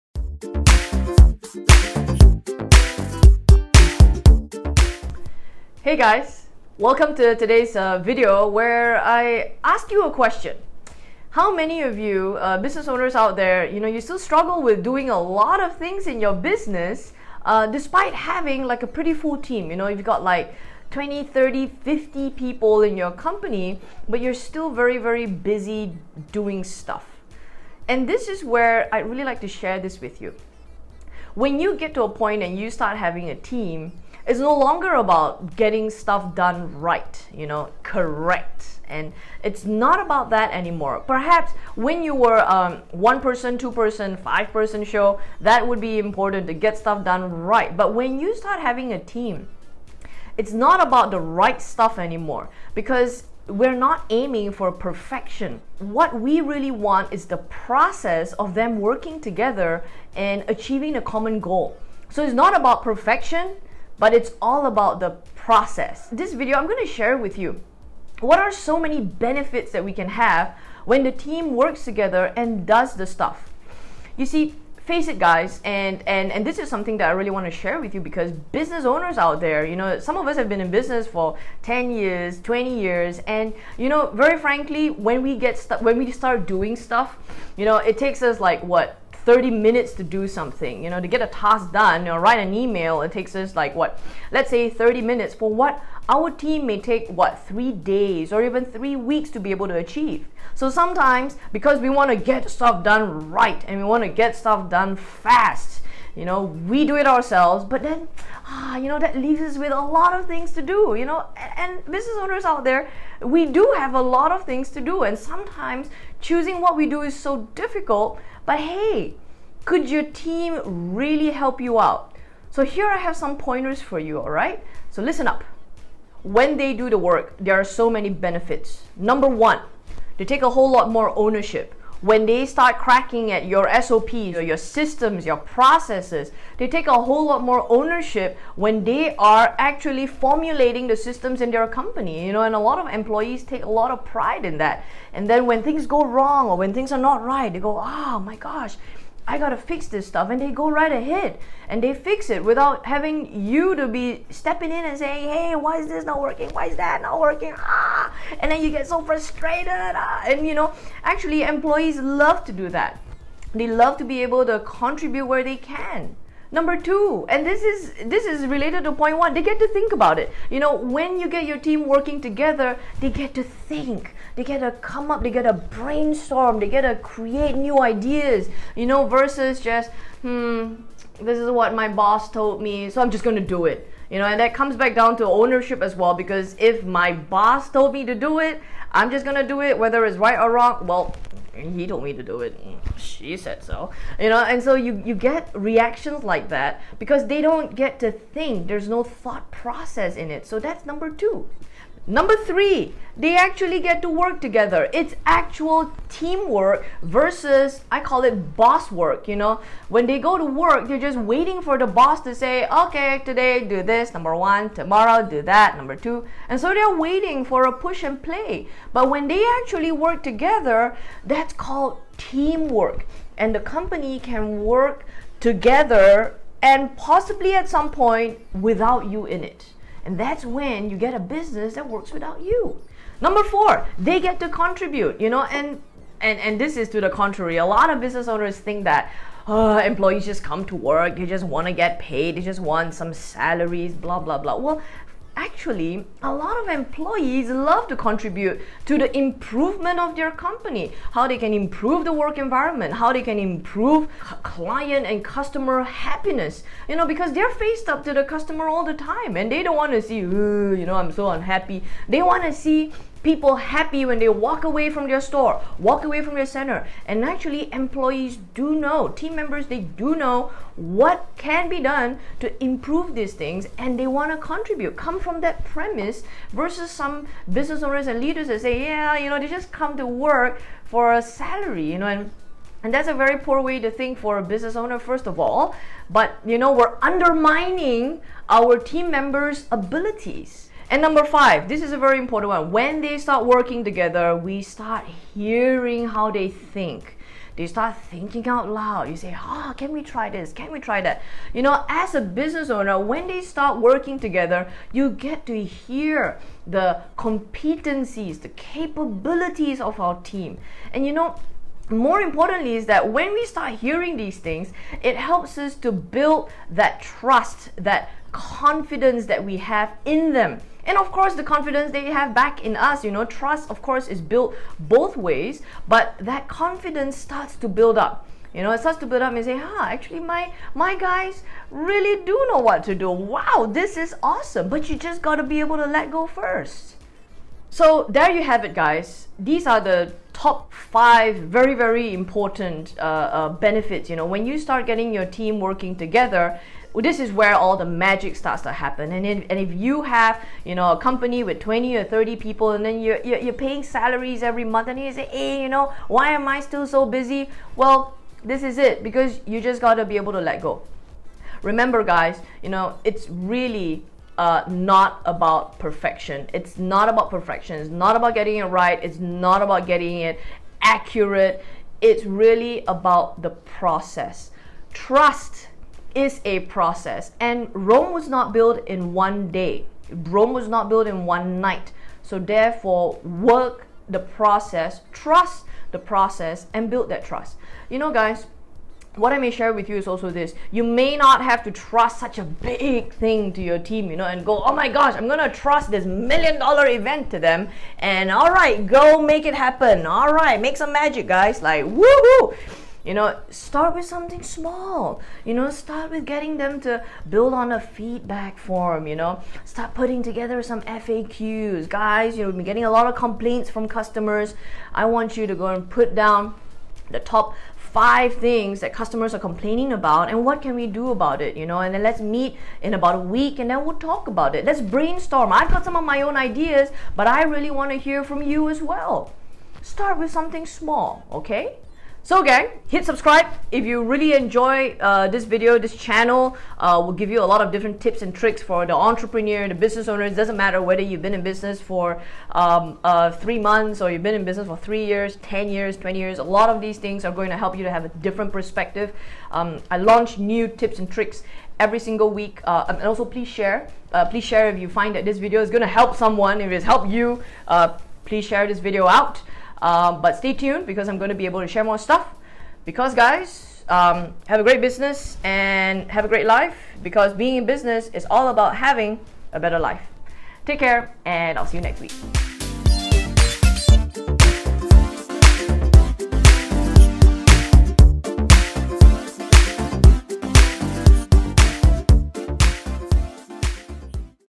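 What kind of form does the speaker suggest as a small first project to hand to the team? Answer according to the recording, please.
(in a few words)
a feedback form.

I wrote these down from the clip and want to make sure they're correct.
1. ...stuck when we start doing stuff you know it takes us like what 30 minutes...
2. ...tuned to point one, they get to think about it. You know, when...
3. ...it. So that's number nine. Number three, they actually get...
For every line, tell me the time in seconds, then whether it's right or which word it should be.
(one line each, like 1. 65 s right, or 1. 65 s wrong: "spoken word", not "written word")
1. 85 s right
2. 168 s wrong: "related", not "tuned"
3. 200 s wrong: "two", not "nine".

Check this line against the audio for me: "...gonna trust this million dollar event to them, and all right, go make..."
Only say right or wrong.
right.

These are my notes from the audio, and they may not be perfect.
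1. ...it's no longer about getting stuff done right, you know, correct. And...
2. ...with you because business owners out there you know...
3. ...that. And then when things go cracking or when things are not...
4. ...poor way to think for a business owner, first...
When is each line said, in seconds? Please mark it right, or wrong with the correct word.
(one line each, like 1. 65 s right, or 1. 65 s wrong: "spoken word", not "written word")
1. 34 s right
2. 77 s right
3. 144 s wrong: "wrong", not "cracking"
4. 283 s right.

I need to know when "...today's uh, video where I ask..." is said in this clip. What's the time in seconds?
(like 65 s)
7 s.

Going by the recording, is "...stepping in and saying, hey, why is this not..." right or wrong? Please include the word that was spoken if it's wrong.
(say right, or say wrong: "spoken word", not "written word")
right.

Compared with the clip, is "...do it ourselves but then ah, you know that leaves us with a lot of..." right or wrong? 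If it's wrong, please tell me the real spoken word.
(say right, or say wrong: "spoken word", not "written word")
right.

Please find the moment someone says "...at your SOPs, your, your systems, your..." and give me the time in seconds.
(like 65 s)
133 s.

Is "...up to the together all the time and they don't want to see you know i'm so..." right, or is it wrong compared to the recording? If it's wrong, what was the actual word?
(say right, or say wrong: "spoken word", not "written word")
wrong: "customer", not "together".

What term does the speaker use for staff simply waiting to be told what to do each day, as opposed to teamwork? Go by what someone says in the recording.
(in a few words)
boss work.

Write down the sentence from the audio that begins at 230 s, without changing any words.
And that's when you get a business that works without you.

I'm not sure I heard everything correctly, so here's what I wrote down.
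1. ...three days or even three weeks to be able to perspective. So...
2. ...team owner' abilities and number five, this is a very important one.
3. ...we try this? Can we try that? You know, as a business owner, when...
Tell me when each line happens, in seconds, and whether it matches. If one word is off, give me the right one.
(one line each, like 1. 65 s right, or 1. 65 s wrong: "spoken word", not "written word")
1. 97 s wrong: "achieve", not "perspective"
2. 288 s wrong: "members", not "owner"
3. 299 s right.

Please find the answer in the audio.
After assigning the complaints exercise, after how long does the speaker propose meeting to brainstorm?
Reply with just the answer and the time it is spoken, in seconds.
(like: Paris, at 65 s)
about a week, at 422 s.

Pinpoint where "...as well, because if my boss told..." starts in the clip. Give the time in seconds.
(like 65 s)
185 s.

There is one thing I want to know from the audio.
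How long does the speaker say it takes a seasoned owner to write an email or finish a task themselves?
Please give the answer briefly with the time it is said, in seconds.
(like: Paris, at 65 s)
30 minutes, at 94 s.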